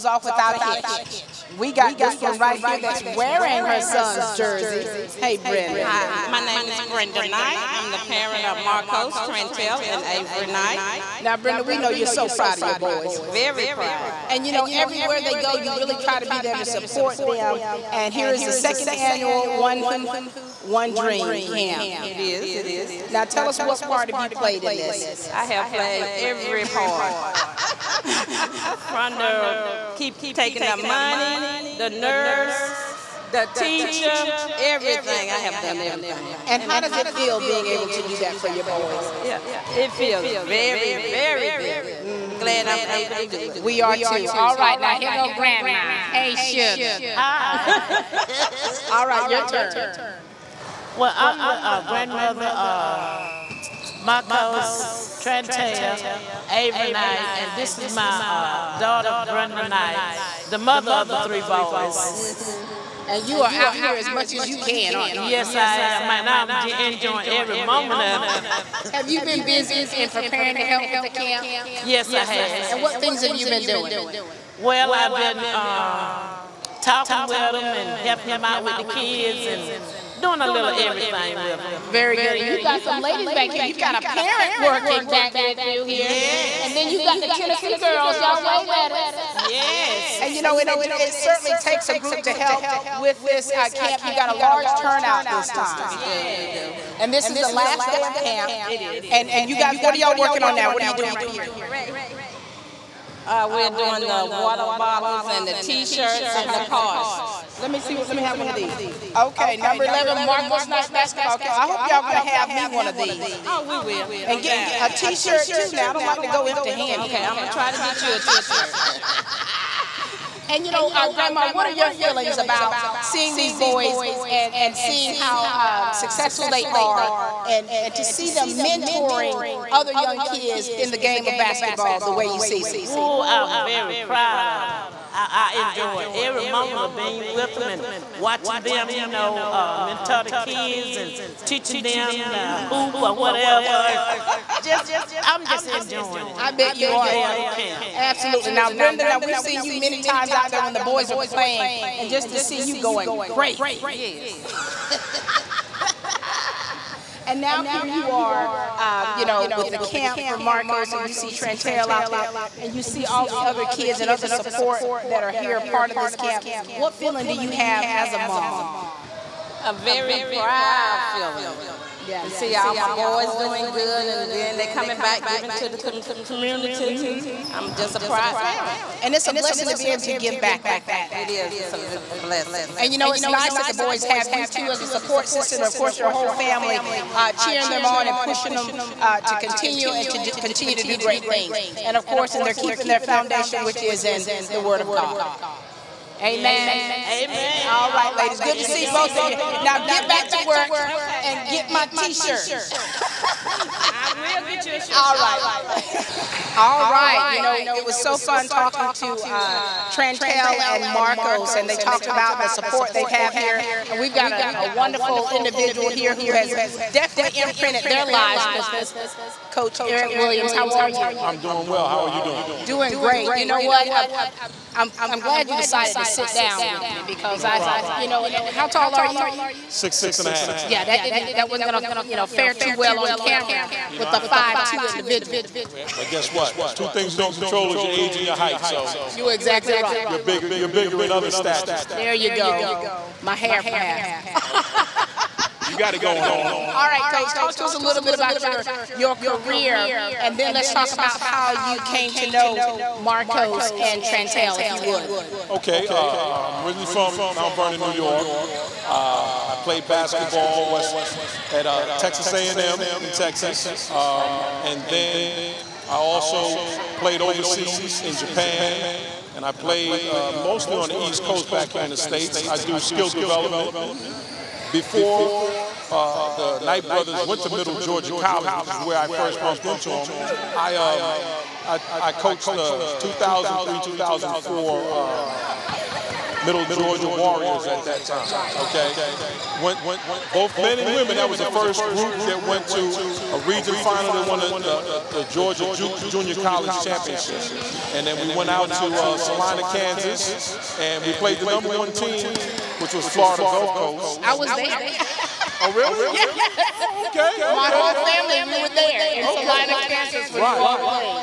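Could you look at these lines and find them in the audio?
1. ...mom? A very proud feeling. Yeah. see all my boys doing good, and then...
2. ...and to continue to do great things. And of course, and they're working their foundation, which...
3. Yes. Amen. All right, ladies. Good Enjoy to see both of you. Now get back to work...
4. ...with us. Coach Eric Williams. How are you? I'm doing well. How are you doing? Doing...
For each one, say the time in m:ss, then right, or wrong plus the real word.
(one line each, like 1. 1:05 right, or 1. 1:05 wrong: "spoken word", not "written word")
1. 2:48 right
2. 3:09 wrong: "keeping", not "working"
3. 3:16 right
4. 3:38 right.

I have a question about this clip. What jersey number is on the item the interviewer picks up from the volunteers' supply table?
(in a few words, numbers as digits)
11.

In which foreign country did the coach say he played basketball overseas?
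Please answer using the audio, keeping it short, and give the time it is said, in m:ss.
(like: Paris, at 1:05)
Japan, at 4:28.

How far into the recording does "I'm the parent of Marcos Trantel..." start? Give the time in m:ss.
0:07.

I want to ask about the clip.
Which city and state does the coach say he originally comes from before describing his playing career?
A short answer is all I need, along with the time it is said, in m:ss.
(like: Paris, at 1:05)
Mount Vernon, New York, at 4:17.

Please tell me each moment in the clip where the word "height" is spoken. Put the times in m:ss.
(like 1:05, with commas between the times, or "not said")
3:58.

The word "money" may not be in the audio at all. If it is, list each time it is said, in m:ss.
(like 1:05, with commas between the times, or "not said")
0:30.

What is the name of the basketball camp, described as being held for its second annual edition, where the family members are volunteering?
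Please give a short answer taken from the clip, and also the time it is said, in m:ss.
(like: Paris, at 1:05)
One Hoop, One Dream, at 0:19.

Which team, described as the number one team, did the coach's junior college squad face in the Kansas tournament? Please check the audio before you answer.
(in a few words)
Florida Gulf Coast.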